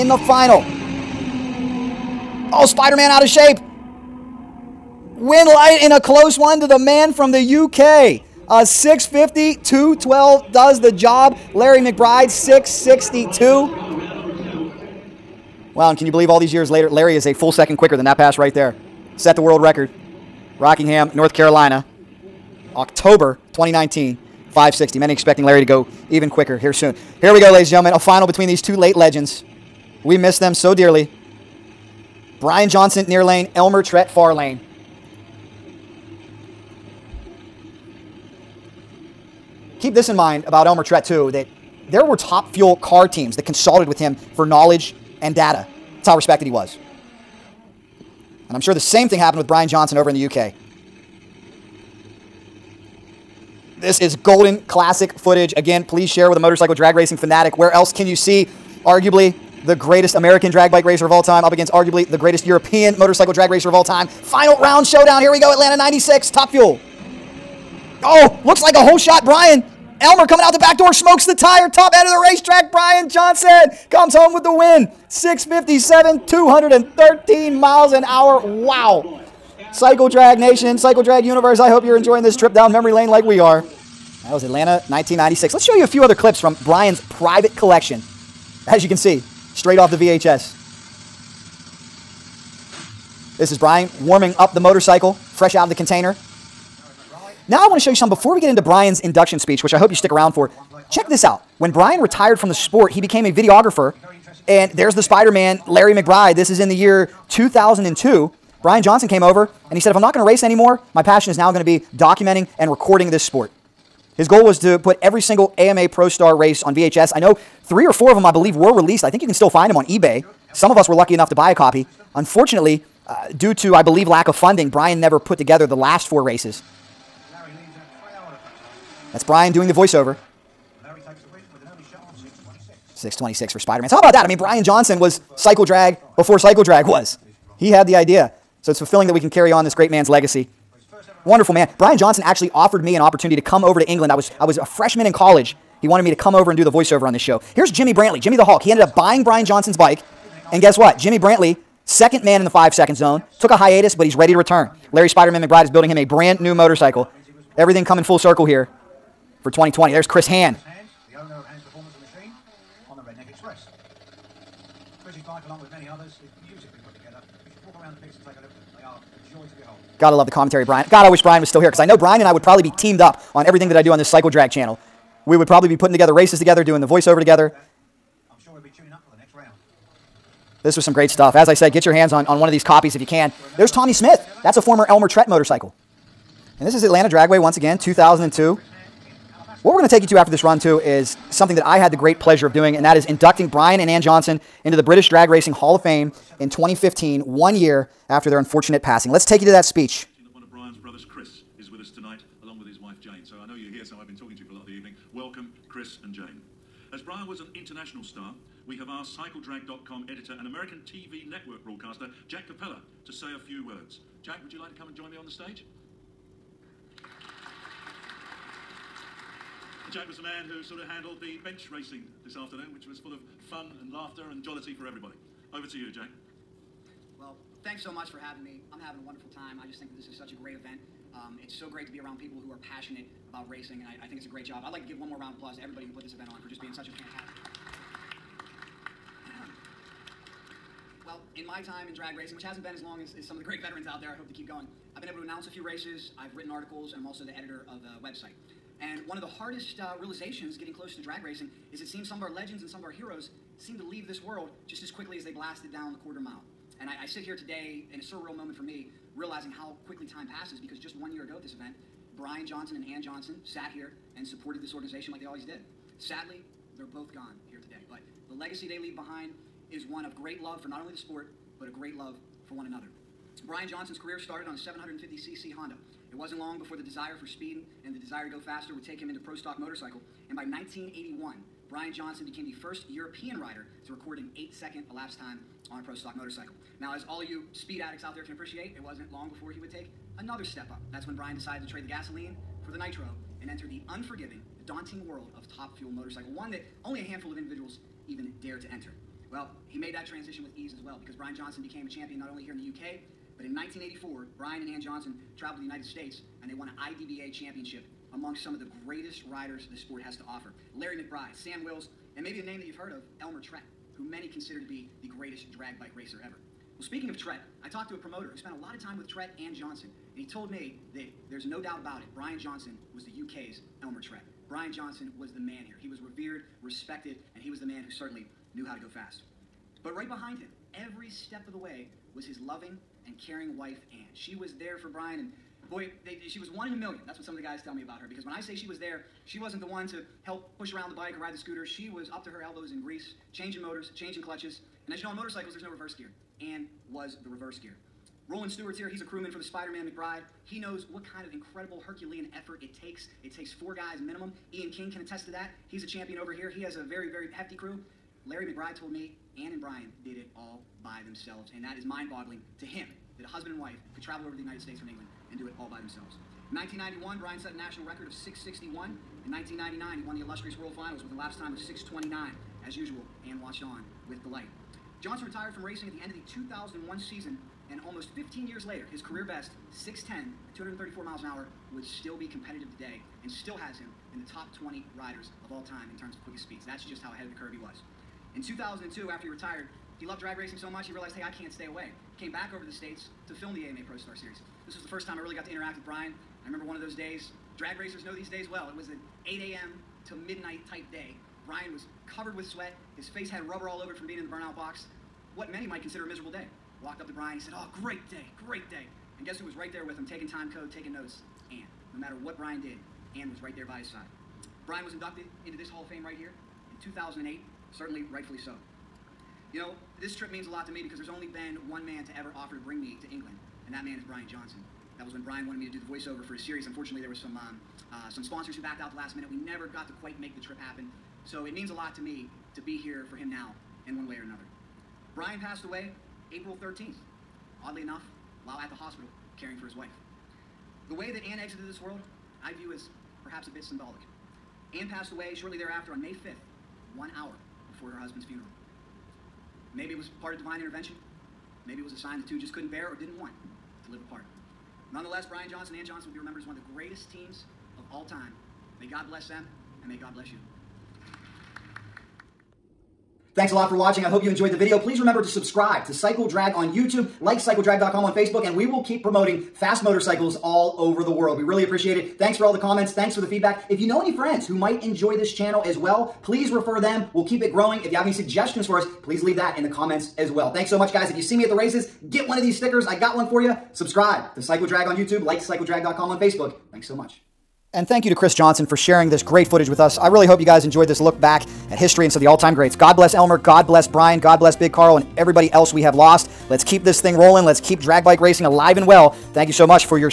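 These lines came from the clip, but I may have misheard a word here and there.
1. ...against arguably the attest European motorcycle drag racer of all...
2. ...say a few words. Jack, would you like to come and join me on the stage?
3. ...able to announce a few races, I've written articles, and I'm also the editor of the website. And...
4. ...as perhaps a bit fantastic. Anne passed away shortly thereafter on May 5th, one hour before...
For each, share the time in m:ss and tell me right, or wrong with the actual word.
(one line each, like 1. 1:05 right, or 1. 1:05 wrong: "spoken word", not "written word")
1. 1:01 wrong: "greatest", not "attest"
2. 3:33 right
3. 4:05 right
4. 7:22 wrong: "symbolic", not "fantastic".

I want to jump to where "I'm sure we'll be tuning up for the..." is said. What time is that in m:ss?
2:58.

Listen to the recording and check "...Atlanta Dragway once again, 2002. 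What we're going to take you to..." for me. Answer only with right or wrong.
right.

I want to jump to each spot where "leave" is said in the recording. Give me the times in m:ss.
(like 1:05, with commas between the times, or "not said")
4:13, 4:28, 7:59.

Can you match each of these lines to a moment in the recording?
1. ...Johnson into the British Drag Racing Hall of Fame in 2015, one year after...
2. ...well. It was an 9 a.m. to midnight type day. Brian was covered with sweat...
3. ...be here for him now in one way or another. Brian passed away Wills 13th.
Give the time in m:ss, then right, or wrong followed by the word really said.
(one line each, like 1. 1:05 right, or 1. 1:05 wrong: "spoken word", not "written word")
1. 3:14 right
2. 6:38 wrong: "8", not "9"
3. 7:12 wrong: "April", not "Wills".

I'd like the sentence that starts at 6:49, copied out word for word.
And guess who was right there with him, taking time code, taking notes?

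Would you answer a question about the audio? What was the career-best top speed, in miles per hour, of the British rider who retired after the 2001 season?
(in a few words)
234.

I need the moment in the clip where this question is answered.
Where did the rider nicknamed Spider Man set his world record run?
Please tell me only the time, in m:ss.
0:20.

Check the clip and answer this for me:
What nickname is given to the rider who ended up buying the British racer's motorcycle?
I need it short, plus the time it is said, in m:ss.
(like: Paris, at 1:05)
The Hulk, at 2:28.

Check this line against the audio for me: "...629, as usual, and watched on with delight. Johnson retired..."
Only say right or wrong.
right.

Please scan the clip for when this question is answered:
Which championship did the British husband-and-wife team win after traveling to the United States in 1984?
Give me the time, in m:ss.
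5:06.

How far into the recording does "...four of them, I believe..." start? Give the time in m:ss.
1:57.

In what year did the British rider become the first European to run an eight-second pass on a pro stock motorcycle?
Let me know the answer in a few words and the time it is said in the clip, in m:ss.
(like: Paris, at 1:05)
1981, at 4:40.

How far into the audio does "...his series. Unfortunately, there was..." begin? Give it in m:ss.
7:06.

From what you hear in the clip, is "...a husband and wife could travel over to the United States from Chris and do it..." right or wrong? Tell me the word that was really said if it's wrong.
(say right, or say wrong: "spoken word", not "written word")
wrong: "England", not "Chris".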